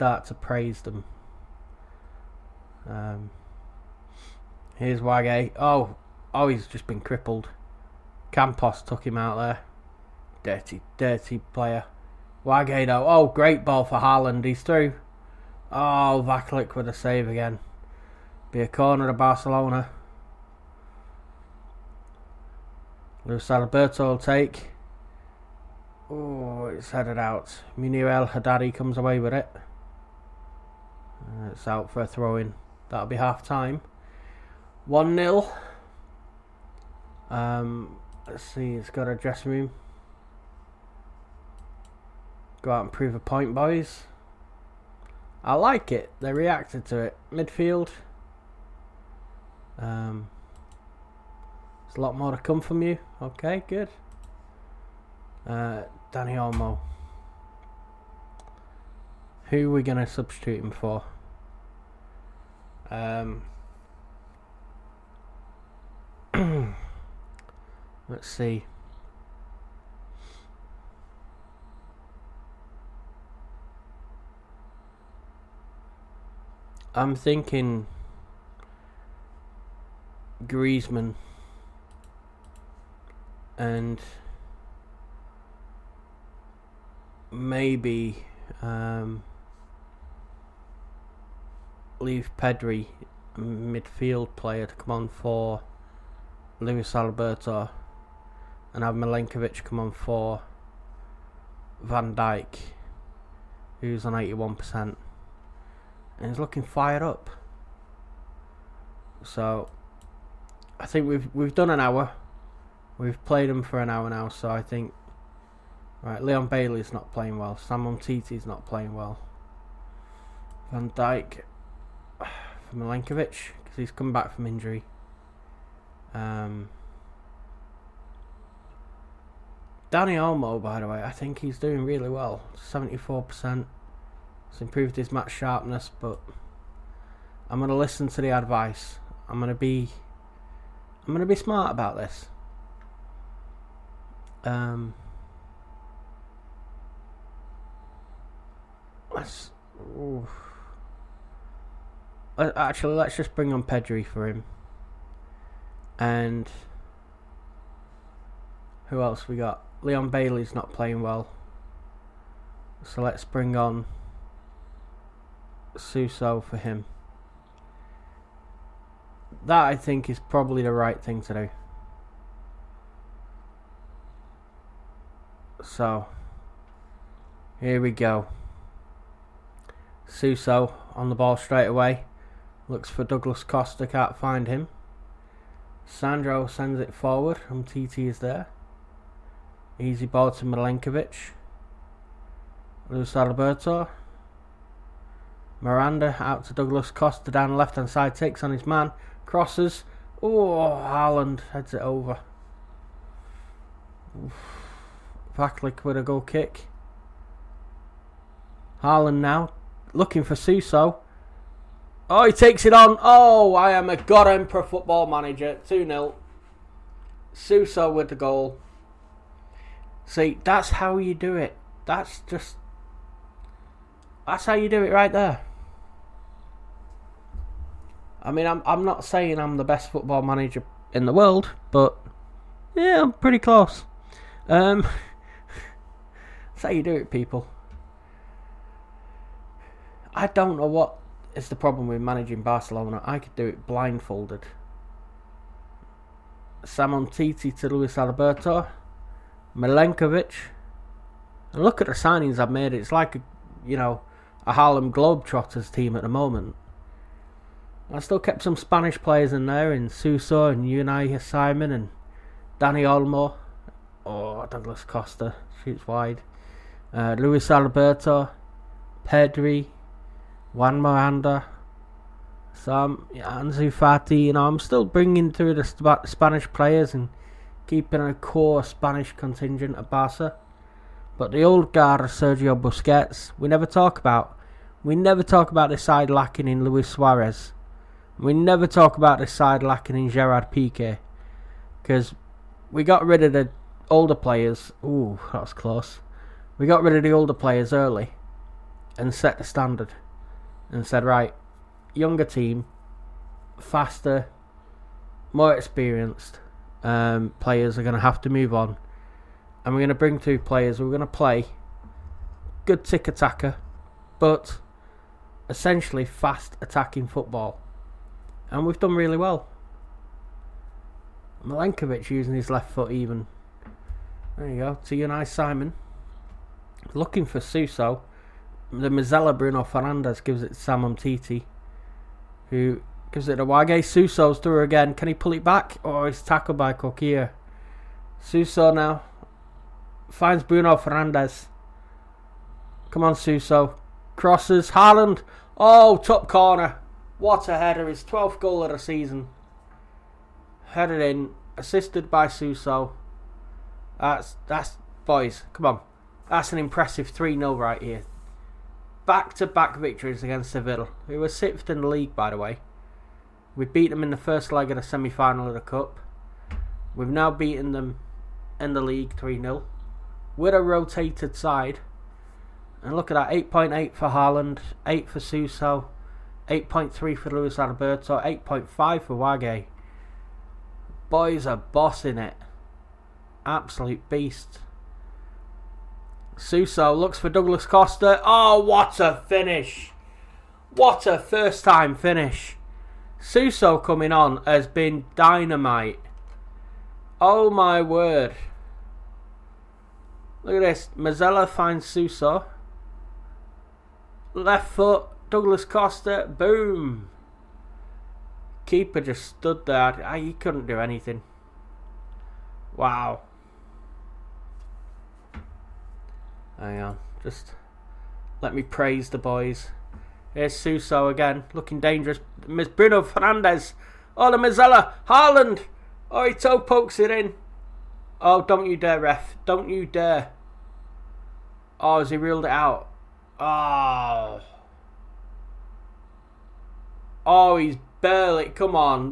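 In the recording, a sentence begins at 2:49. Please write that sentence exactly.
That I think is probably the right thing to do.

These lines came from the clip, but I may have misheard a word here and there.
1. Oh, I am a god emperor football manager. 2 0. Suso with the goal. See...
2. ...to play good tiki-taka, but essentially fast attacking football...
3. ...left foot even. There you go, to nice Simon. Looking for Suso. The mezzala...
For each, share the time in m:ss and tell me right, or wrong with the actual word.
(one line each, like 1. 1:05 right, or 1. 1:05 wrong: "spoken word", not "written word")
1. 3:32 right
2. 5:11 right
3. 5:22 right.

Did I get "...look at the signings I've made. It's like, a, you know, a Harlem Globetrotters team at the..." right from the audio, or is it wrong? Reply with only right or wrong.
right.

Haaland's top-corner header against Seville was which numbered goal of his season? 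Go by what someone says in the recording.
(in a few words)
12th.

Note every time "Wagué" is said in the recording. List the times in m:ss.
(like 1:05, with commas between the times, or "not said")
0:04, 0:12, 5:33, 6:19.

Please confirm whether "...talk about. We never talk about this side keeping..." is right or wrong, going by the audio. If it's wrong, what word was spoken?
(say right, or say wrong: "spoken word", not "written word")
wrong: "lacking", not "keeping".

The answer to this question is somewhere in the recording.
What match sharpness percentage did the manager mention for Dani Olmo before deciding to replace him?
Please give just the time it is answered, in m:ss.
2:12.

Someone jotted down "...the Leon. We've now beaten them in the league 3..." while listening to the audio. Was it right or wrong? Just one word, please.
wrong.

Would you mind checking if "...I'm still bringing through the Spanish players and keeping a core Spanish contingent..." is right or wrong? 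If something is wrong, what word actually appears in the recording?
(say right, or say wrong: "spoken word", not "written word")
right.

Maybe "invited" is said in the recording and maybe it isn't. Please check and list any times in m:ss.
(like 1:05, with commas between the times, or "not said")
not said.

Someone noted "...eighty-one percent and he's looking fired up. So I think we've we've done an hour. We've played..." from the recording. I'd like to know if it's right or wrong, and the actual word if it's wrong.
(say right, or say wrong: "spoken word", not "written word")
right.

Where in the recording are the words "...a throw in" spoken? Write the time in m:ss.
0:32.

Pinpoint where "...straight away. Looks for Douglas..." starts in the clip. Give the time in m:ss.
3:01.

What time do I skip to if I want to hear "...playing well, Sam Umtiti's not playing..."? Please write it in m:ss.
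1:57.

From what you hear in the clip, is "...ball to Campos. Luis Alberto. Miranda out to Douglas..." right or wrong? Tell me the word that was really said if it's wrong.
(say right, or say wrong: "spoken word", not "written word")
wrong: "Milenkovic", not "Campos".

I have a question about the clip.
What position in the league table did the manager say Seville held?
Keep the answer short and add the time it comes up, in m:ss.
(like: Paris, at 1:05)
6th, at 6:01.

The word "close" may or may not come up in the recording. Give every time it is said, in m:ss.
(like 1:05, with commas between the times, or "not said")
3:53, 4:55.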